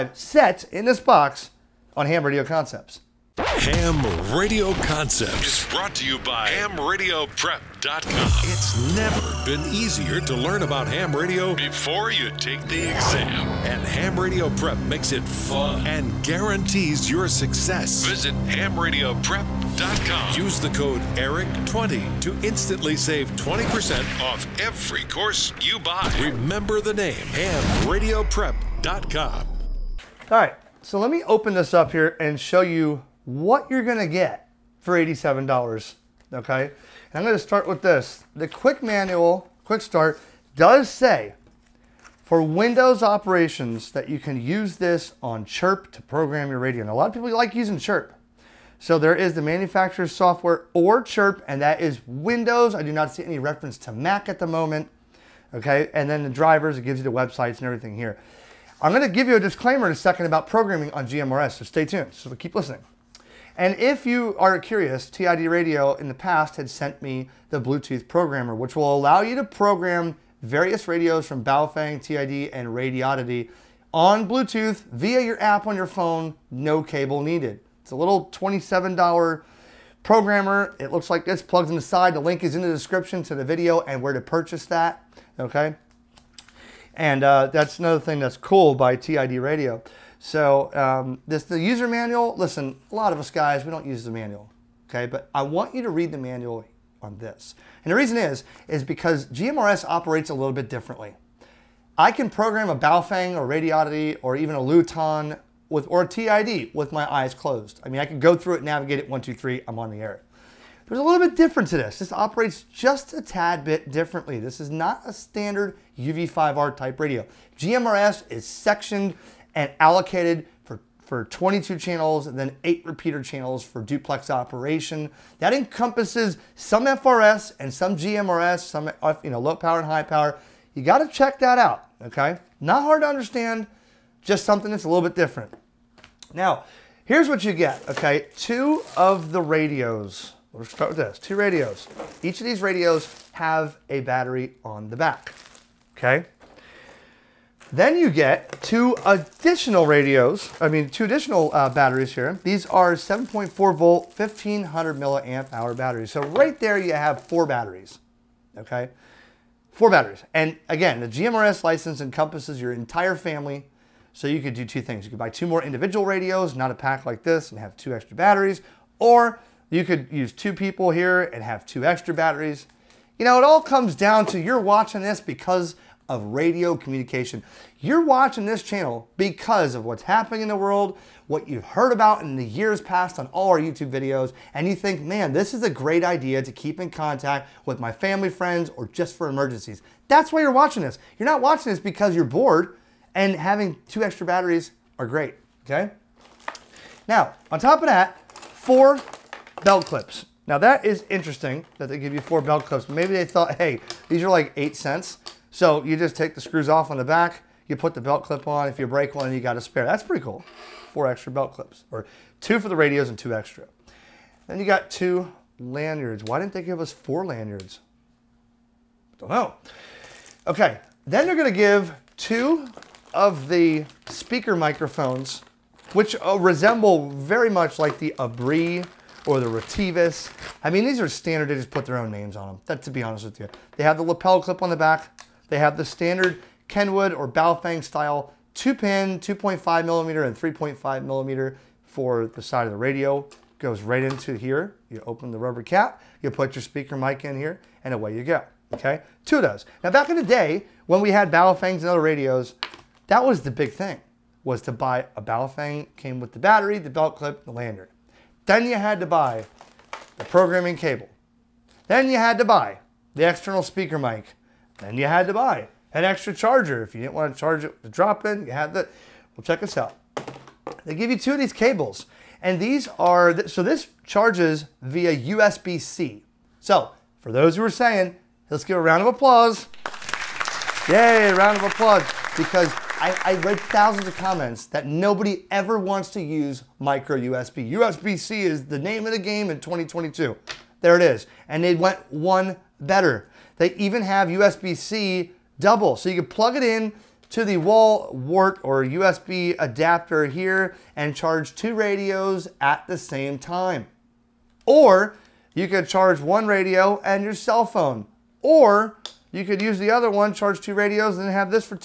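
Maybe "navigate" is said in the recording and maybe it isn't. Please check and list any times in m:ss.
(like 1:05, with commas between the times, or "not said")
1:48.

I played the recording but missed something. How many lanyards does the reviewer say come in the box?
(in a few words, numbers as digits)
2.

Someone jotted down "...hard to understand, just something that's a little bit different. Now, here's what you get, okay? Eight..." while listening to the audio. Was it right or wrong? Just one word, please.
wrong.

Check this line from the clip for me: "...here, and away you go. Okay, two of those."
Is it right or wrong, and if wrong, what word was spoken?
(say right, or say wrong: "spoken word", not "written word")
right.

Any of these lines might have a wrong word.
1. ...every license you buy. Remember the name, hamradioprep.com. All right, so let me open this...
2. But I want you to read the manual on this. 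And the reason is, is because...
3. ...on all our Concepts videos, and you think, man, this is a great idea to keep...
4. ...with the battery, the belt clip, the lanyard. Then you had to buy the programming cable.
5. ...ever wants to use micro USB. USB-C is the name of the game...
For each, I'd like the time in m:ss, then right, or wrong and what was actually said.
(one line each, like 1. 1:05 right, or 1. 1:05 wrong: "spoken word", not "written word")
1. 0:24 wrong: "course", not "license"
2. 1:35 right
3. 3:03 wrong: "YouTube", not "Concepts"
4. 4:16 right
5. 4:45 right.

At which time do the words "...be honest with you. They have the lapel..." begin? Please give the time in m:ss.
3:52.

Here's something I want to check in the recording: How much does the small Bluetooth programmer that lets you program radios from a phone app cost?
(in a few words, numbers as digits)
$27.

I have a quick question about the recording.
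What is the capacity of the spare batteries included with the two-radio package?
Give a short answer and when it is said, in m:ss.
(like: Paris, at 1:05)
1500 milliamp hour, at 2:34.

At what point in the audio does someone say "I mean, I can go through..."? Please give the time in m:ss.
1:47.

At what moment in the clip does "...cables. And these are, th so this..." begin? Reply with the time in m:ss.
4:31.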